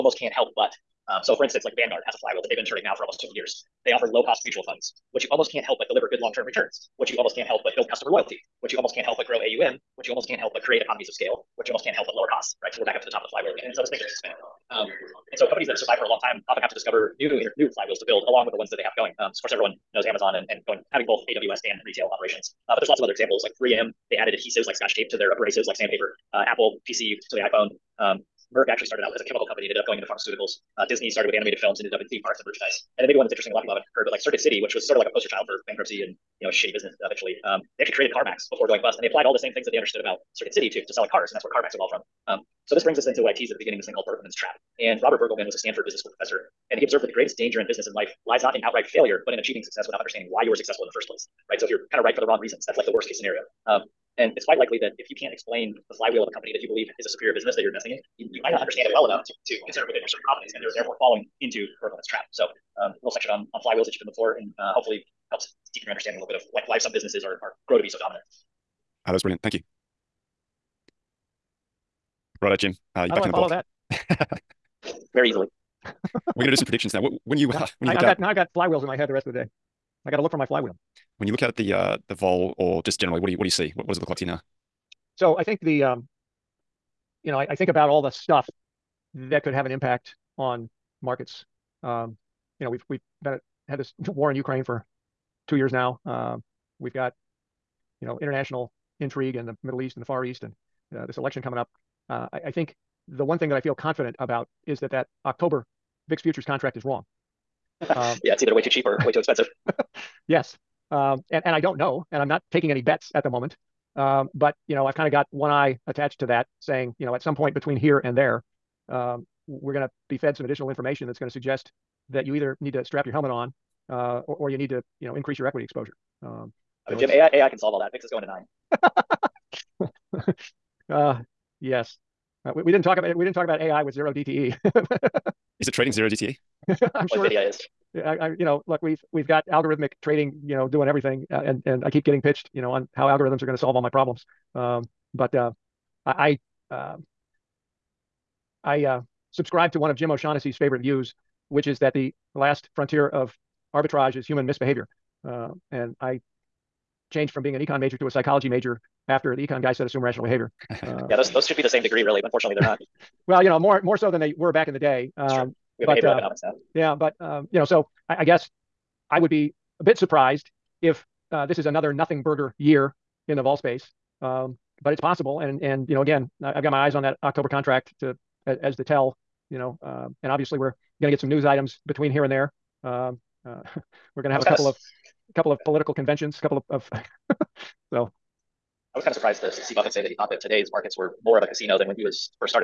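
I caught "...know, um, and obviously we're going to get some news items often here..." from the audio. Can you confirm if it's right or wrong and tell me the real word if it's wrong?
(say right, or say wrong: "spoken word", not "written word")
wrong: "between", not "often".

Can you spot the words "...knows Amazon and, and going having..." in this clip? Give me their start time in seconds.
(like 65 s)
19 s.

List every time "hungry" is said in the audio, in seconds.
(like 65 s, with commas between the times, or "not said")
not said.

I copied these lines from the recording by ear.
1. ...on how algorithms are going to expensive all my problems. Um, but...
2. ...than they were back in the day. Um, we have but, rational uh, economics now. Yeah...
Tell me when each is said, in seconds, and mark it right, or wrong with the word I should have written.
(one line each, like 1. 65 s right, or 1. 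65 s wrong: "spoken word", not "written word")
1. 142 s wrong: "solve", not "expensive"
2. 164 s wrong: "behavioral", not "rational".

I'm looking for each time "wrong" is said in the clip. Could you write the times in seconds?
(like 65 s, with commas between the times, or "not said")
52 s, 106 s.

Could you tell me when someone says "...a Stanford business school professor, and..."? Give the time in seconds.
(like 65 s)
45 s.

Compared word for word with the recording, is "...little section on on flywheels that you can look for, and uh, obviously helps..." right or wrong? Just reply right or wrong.
wrong.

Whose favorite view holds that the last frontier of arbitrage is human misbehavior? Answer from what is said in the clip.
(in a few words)
Jim O'Shaughnessy.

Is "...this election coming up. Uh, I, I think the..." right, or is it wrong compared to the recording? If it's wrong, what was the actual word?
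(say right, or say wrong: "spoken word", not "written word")
right.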